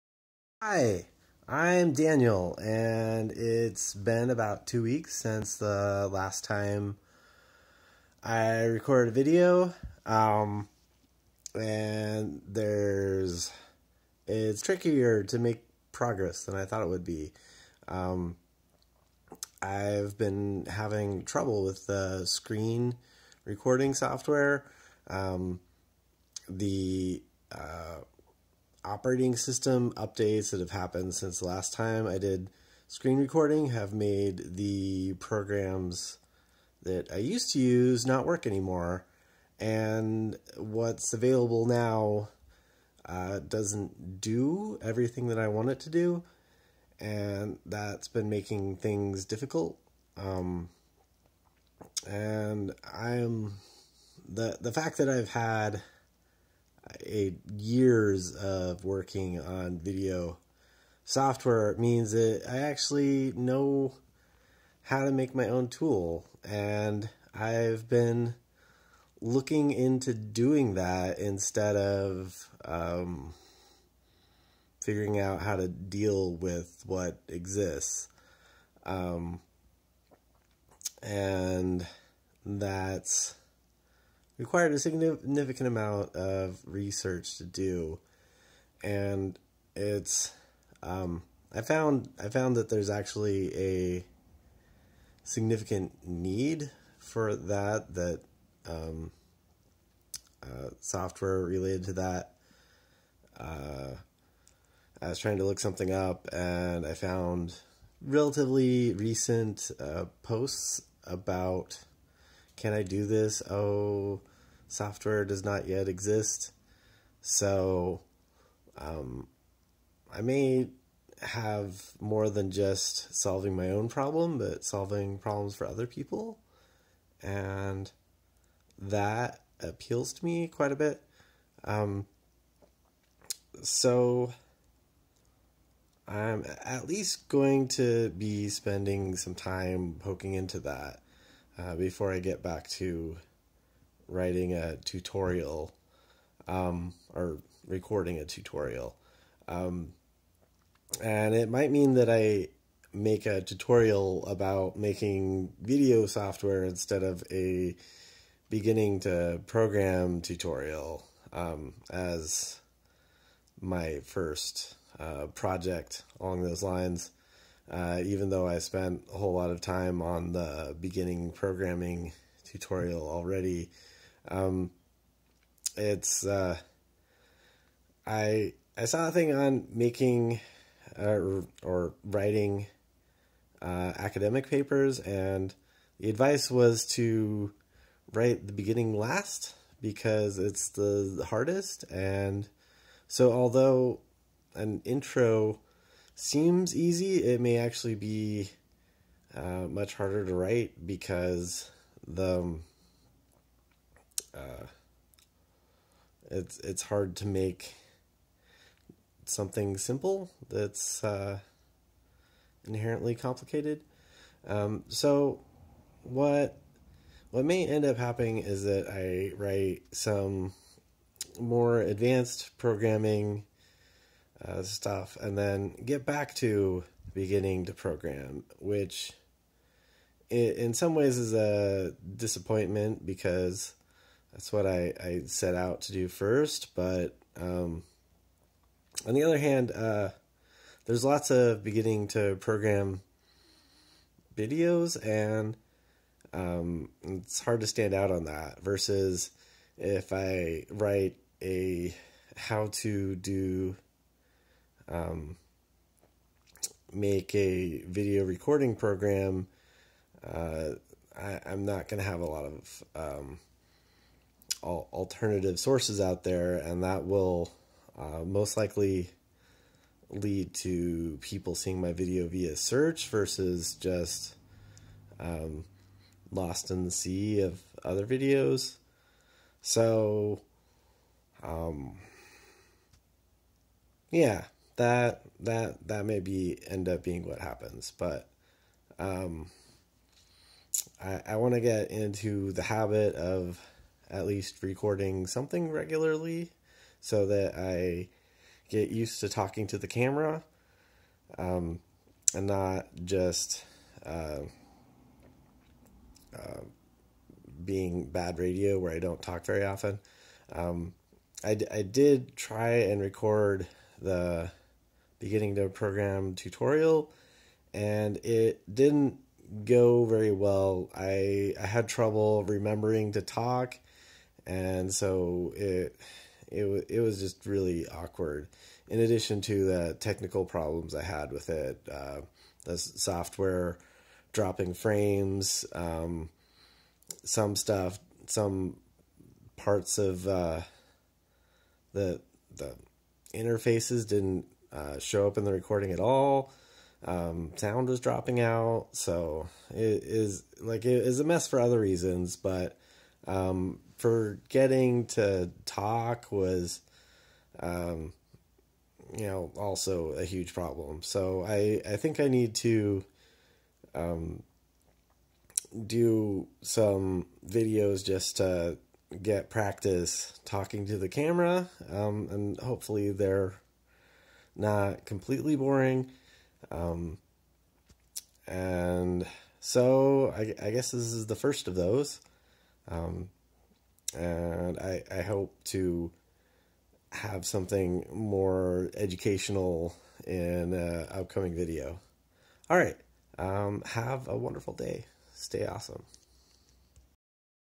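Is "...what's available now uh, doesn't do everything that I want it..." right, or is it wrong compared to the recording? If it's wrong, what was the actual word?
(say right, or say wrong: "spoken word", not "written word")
right.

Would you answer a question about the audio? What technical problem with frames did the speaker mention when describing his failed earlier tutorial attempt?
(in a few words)
dropping frames.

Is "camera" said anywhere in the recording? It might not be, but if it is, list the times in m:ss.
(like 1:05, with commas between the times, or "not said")
4:59, 6:11.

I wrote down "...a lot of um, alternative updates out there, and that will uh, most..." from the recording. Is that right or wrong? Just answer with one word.
wrong.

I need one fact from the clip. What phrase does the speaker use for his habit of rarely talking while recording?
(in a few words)
bad radio.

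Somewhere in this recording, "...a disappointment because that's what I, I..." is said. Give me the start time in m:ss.
3:51.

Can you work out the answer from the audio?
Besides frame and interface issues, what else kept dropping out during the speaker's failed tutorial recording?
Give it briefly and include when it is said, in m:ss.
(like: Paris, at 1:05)
sound, at 5:47.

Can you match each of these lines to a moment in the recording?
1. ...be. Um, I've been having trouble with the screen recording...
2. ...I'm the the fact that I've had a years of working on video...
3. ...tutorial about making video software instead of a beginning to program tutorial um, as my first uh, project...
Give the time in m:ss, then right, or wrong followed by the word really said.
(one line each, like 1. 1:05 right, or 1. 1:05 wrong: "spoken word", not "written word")
1. 0:17 right
2. 0:52 right
3. 2:33 right.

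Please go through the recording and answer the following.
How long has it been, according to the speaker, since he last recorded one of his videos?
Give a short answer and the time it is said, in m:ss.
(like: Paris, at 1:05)
2 weeks, at 0:04.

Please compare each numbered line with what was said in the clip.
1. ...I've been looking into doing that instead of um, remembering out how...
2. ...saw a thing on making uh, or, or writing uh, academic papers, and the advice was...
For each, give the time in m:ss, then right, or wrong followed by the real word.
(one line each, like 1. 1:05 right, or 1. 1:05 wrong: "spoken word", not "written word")
1. 1:07 wrong: "figuring", not "remembering"
2. 2:58 right.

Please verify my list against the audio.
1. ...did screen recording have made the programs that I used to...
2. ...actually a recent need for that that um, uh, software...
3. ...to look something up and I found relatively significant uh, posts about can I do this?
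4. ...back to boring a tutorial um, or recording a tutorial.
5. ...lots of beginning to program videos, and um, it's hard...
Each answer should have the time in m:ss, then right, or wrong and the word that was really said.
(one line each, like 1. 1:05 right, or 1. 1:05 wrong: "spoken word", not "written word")
1. 0:32 right
2. 1:32 wrong: "significant", not "recent"
3. 1:45 wrong: "recent", not "significant"
4. 2:22 wrong: "writing", not "boring"
5. 4:01 right.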